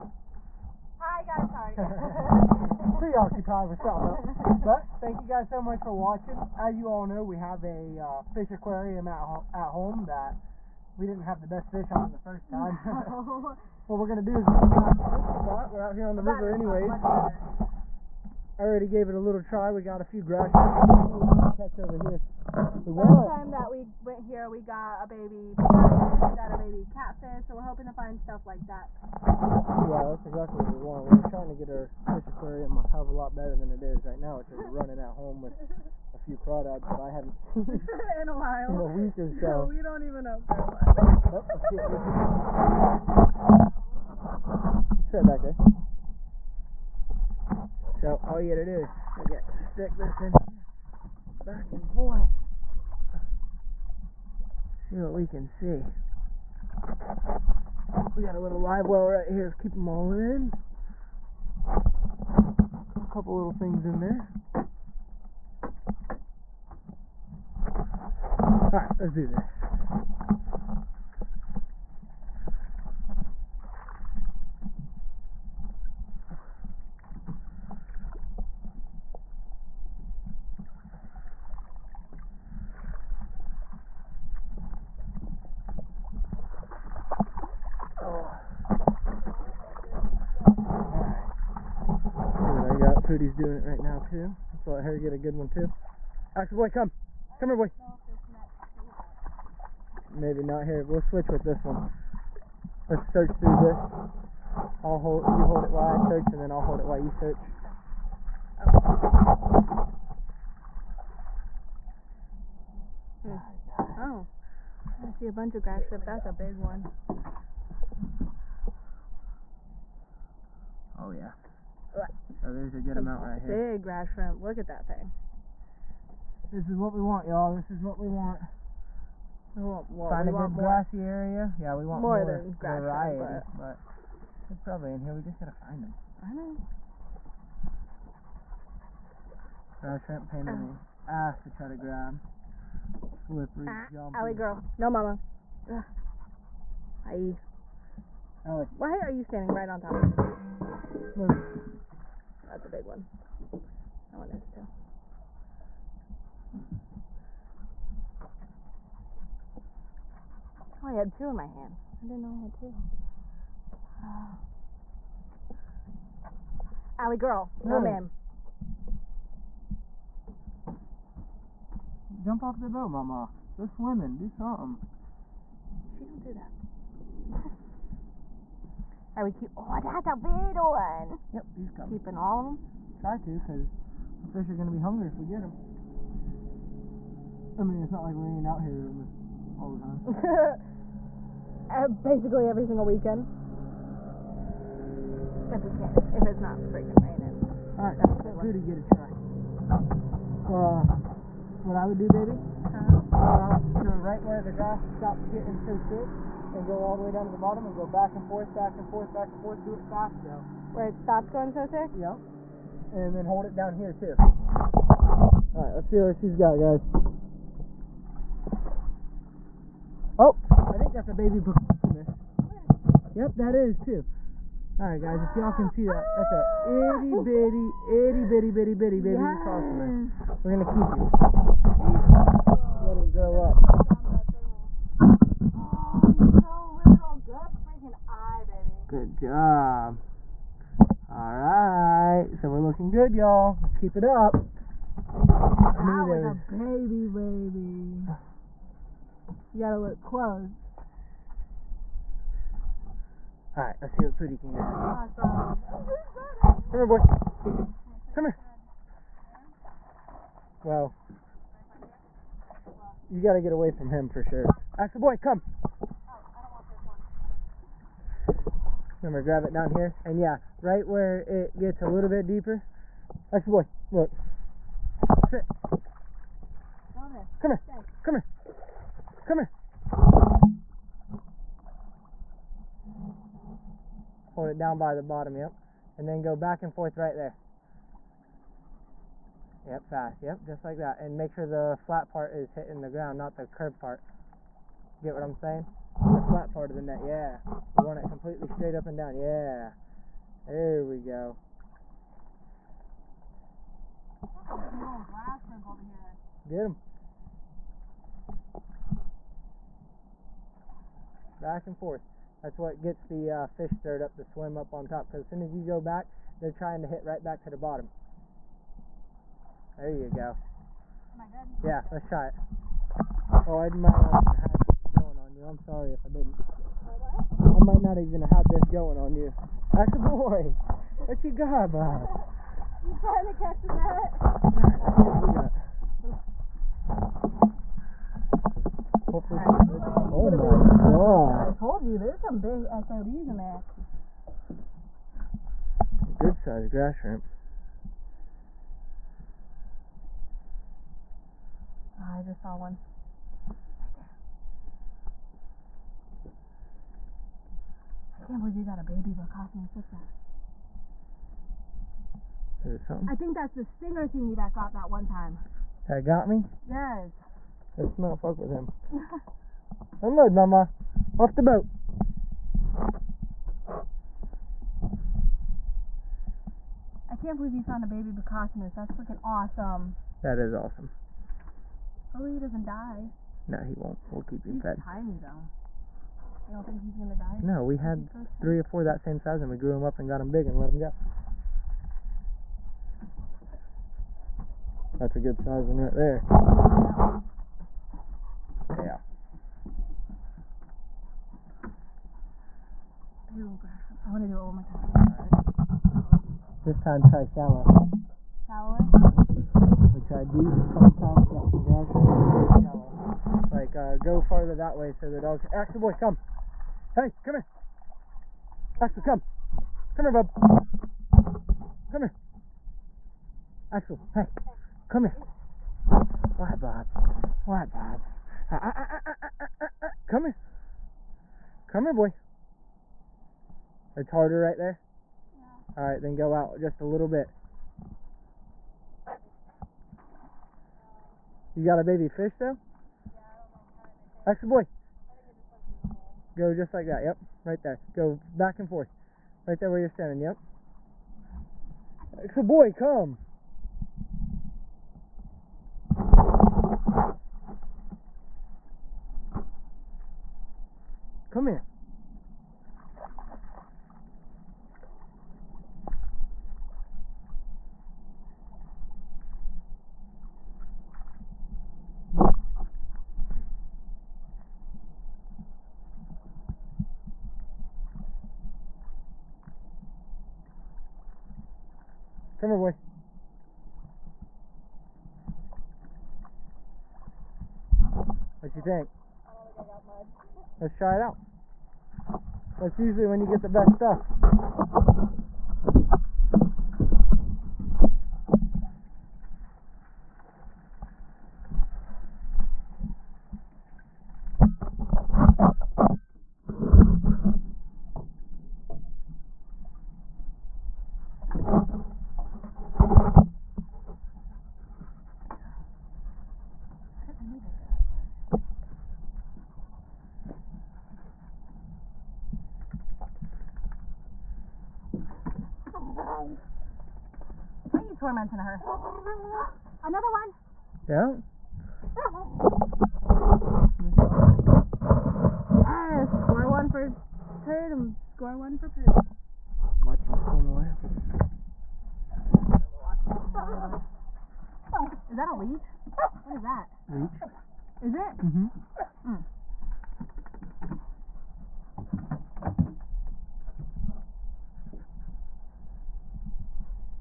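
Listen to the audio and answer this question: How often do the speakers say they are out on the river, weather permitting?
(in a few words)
Every single weekend.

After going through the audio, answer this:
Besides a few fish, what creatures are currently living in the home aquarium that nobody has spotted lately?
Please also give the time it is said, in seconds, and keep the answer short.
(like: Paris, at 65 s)
Crawdads, at 36 s.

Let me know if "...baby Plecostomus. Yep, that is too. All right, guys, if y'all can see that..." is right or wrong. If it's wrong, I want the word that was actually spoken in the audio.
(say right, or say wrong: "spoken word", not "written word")
right.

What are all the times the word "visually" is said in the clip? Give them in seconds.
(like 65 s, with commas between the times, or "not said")
not said.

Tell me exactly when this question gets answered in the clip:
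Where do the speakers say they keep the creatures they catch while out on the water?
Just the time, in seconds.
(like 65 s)
58 s.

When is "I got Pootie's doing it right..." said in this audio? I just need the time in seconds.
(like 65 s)
92 s.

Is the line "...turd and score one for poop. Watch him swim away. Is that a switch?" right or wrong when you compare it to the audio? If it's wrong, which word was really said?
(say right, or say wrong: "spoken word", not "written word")
wrong: "leech", not "switch".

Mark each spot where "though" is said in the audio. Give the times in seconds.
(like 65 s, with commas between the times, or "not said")
210 s, 385 s, 442 s.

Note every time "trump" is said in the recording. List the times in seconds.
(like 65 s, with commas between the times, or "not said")
not said.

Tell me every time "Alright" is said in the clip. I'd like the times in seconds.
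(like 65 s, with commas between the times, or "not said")
68 s, 241 s, 253 s.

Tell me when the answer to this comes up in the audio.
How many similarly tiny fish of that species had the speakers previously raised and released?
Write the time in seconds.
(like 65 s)
388 s.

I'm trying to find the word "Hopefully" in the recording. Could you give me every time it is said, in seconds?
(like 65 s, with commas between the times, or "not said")
339 s, 382 s.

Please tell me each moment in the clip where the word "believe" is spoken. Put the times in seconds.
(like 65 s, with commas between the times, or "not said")
358 s, 377 s.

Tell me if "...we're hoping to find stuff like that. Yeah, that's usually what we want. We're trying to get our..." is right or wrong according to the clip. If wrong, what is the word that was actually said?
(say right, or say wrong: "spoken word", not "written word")
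wrong: "exactly", not "usually".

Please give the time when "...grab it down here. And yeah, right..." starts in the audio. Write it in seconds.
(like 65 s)
269 s.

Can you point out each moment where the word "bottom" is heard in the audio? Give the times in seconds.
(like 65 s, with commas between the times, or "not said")
207 s, 285 s, 317 s.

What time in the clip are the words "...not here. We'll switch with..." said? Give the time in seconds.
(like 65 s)
100 s.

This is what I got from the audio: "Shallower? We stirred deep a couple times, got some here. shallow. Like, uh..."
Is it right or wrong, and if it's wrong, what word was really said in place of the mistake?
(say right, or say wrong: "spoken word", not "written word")
wrong: "tried", not "stirred".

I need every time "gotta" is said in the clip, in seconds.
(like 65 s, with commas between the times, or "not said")
48 s, 135 s, 249 s, 263 s.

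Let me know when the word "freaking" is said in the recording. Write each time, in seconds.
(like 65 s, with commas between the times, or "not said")
196 s, 378 s.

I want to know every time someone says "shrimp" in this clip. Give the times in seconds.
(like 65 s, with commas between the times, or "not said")
115 s, 124 s, 133 s, 140 s, 346 s.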